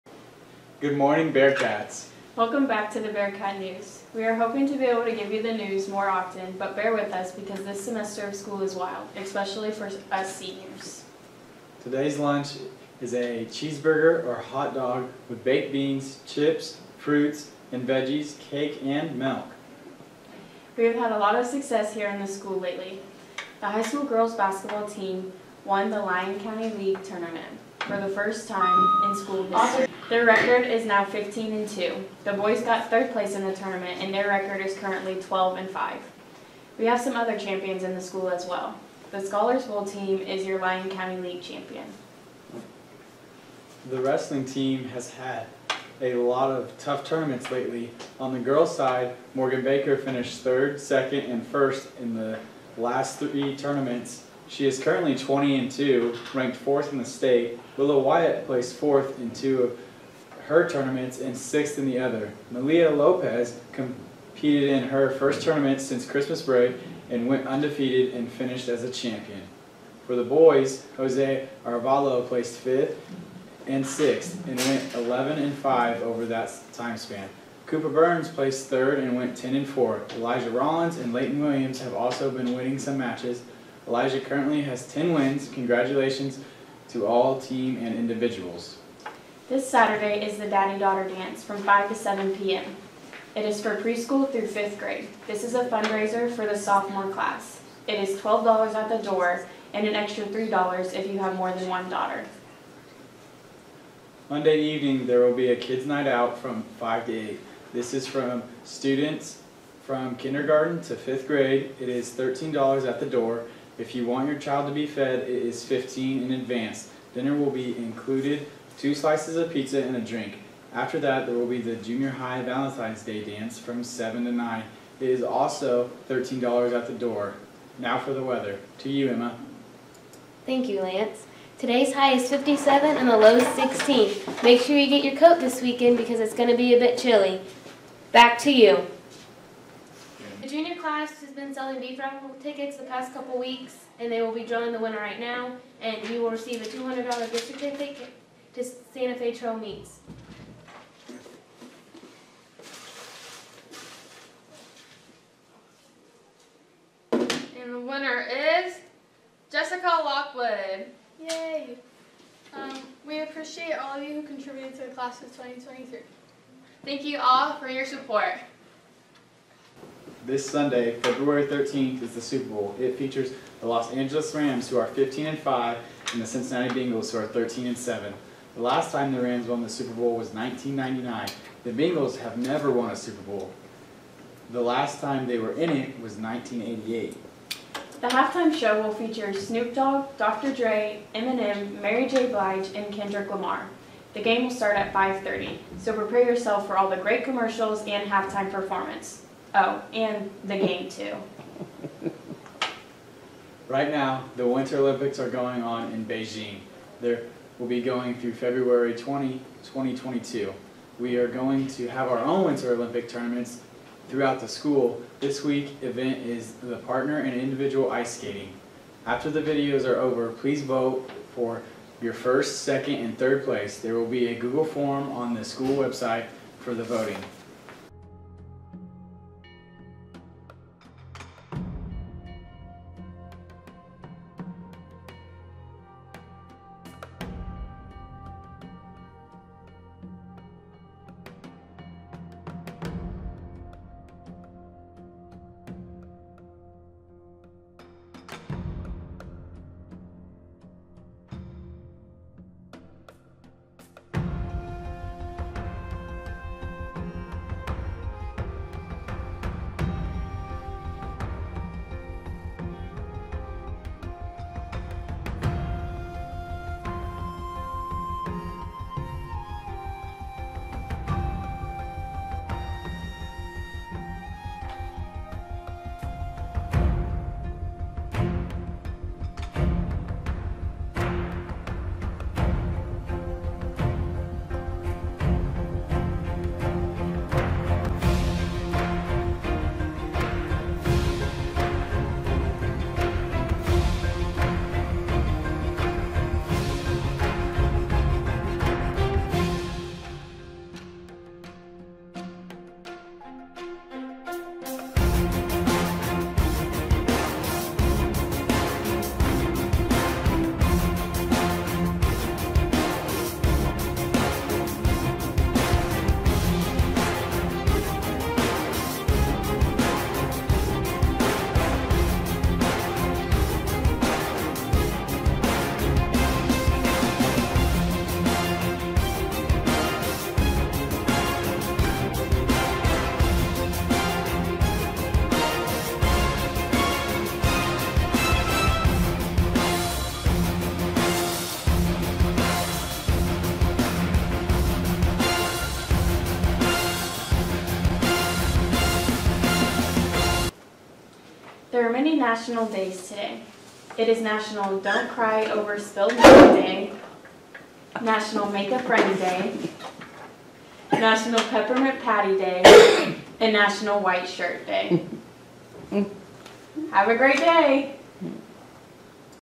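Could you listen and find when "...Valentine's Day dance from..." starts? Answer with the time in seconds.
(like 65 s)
122 s.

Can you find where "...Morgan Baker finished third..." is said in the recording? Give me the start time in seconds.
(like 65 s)
49 s.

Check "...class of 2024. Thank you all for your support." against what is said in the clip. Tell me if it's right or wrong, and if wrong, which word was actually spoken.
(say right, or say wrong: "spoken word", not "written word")
wrong: "2023", not "2024".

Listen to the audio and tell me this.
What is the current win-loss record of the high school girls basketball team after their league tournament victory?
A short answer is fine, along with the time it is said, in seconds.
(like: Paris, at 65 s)
15 and 2, at 31 s.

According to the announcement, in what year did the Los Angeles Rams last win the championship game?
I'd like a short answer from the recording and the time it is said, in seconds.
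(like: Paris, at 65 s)
1999, at 180 s.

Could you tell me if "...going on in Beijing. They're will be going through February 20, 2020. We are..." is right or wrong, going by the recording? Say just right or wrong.
wrong.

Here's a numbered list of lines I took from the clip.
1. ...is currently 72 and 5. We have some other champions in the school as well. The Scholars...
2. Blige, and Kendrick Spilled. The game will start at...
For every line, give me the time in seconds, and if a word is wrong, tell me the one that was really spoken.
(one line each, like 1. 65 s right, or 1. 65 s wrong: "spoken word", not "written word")
1. 34 s wrong: "12", not "72"
2. 192 s wrong: "Lamar", not "Spilled".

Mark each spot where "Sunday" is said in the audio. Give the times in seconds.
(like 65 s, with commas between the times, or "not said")
170 s.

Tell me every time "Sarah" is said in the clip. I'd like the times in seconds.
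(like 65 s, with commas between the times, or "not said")
not said.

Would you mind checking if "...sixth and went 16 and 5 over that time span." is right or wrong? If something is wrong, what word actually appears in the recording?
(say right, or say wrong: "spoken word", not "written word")
wrong: "11", not "16".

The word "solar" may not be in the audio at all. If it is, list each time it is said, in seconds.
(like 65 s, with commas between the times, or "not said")
not said.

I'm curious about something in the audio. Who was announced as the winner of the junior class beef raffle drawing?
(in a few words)
Jessica Lockwood.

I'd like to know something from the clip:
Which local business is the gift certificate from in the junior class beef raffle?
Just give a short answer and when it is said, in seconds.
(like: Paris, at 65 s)
Santa Fe Trail Meats, at 148 s.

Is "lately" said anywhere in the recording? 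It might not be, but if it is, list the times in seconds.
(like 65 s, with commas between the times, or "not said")
22 s, 47 s.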